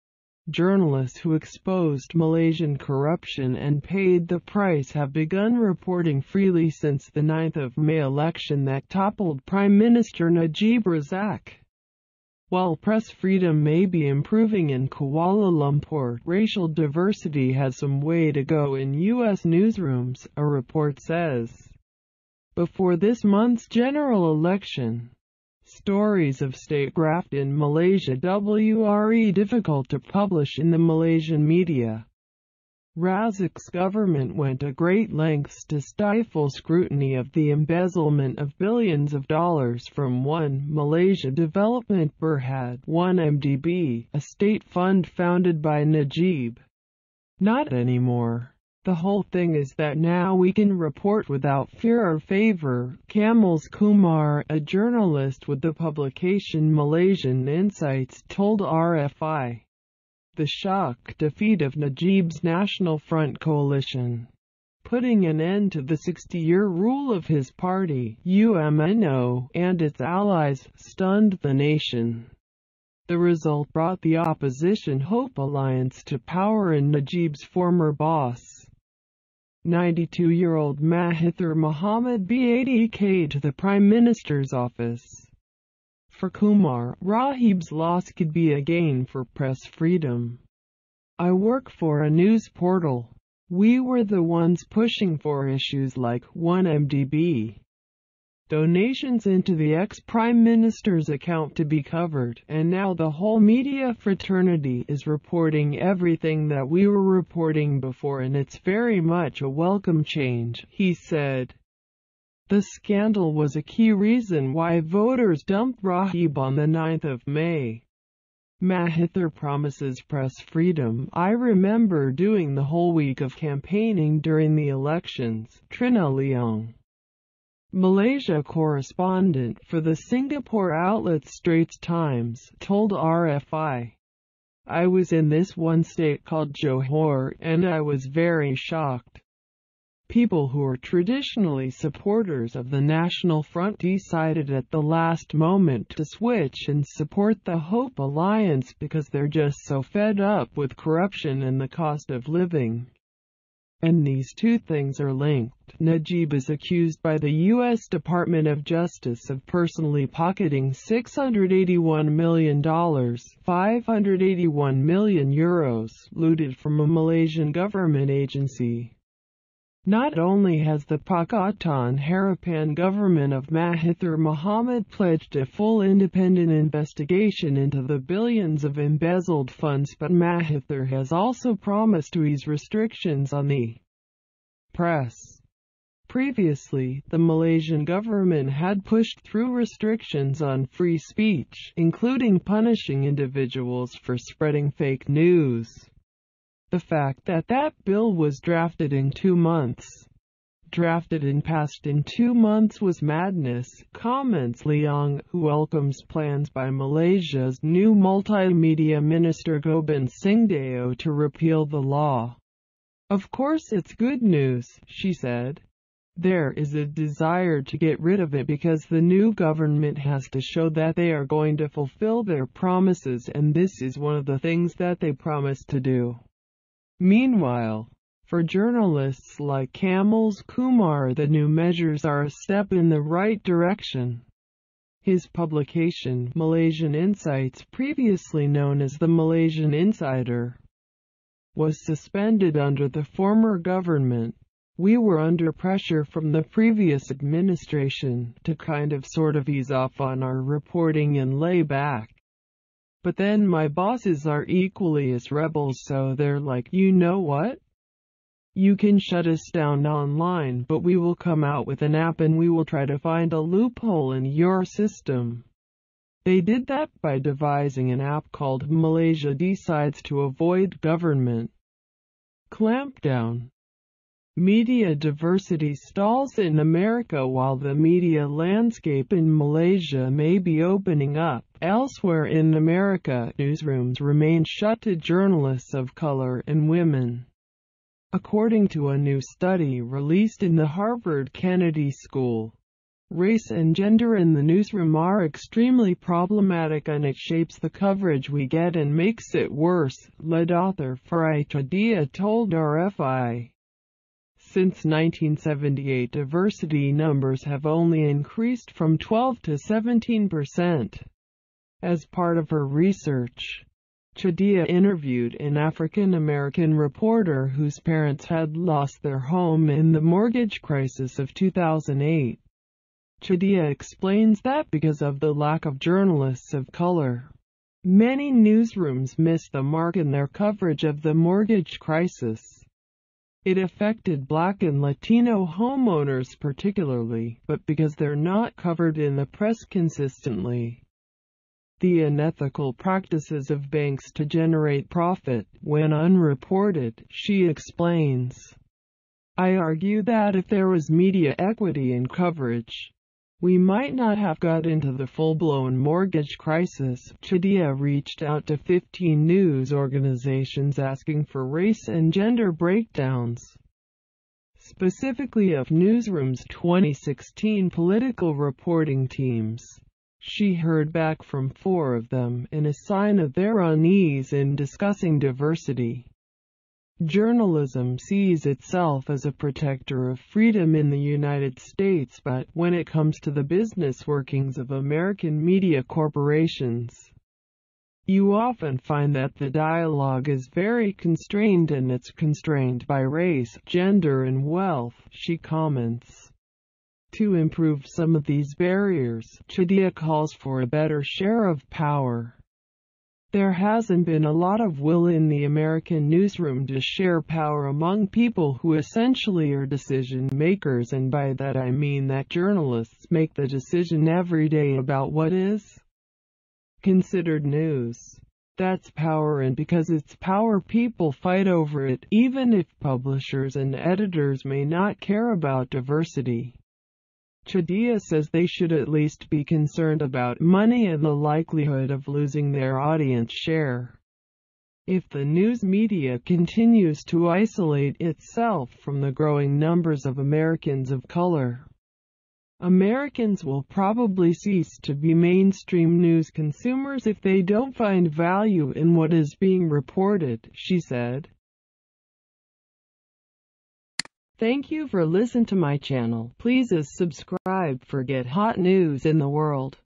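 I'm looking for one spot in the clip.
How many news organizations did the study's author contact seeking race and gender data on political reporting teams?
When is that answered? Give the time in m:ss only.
5:58.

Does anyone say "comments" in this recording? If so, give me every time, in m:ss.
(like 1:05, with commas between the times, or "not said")
3:23, 6:35.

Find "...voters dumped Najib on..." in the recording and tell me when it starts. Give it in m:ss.
1:54.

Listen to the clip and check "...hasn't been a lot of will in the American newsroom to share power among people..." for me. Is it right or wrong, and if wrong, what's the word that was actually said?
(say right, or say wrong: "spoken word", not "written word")
right.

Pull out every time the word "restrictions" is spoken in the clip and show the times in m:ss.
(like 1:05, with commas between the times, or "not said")
3:02, 3:09.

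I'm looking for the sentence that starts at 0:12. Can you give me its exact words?
While press freedom may be improving in Kuala Lumpur, racial diversity has some way to go in U.S.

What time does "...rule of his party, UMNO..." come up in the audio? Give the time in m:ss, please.
1:06.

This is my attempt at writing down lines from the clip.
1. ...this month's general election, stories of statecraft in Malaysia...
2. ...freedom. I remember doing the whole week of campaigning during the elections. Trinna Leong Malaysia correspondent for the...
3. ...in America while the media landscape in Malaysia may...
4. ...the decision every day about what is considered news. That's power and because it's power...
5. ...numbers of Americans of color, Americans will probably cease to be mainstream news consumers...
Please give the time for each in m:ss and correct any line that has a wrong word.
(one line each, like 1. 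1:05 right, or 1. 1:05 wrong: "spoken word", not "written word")
1. 0:22 right
2. 2:00 right
3. 4:36 right
4. 6:53 right
5. 7:19 right.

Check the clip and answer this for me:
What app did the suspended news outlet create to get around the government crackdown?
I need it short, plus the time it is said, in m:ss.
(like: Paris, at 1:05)
Malaysia Decides, at 4:28.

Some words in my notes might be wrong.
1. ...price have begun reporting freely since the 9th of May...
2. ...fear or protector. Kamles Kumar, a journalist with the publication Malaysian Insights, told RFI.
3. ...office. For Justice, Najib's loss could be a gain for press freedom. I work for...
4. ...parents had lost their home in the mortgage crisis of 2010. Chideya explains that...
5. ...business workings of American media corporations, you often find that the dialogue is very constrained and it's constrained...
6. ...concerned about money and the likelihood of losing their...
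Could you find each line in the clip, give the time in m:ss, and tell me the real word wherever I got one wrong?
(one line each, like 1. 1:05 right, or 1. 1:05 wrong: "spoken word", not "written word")
1. 0:04 right
2. 0:51 wrong: "favor", not "protector"
3. 1:24 wrong: "Kumar", not "Justice"
4. 5:17 wrong: "2008", not "2010"
5. 6:23 right
6. 7:09 right.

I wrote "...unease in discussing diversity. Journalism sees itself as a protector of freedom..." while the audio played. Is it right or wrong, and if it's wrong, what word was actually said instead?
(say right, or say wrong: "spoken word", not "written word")
right.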